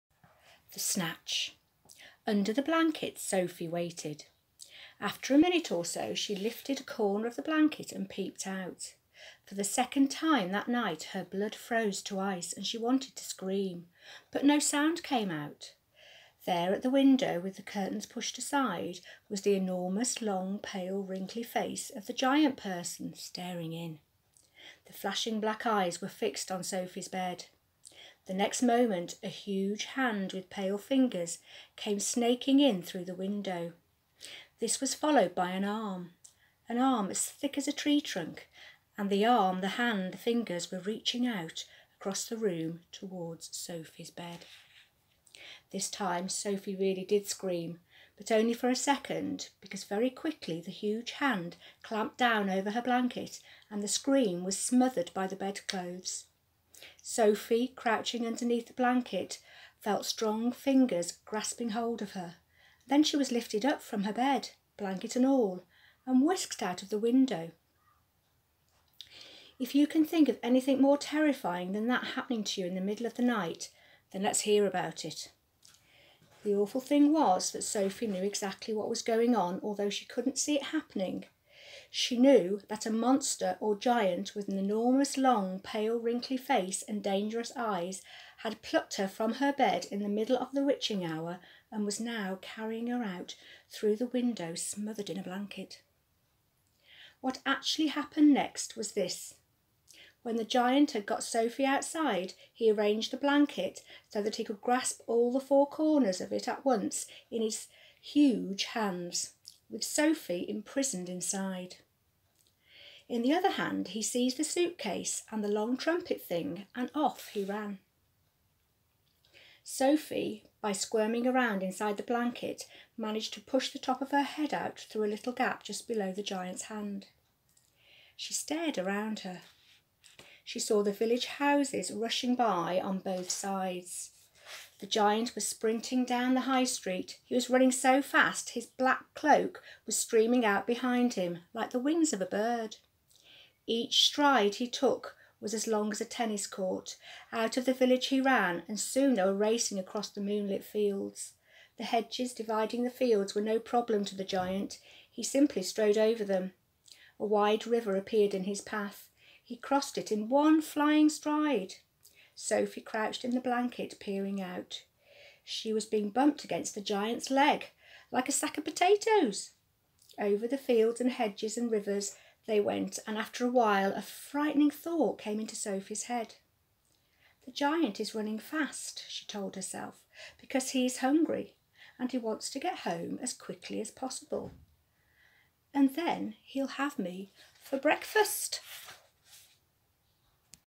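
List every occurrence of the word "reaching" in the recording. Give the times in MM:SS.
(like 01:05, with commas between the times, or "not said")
00:40.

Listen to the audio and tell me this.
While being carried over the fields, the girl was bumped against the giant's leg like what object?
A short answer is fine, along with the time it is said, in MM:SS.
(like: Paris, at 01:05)
a sack of potatoes, at 02:48.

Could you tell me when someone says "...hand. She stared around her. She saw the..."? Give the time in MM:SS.
02:06.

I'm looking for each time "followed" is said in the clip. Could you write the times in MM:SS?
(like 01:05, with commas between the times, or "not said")
00:34.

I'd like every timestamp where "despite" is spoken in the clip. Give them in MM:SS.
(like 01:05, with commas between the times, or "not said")
not said.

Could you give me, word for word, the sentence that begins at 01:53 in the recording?
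In the other hand, he seized the suitcase and the long trumpet thing, and off he ran.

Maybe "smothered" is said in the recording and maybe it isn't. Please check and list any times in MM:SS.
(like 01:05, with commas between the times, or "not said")
00:54, 01:34.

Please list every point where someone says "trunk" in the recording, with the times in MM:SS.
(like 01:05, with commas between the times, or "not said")
00:37.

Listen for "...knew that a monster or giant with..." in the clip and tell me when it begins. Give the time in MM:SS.
01:22.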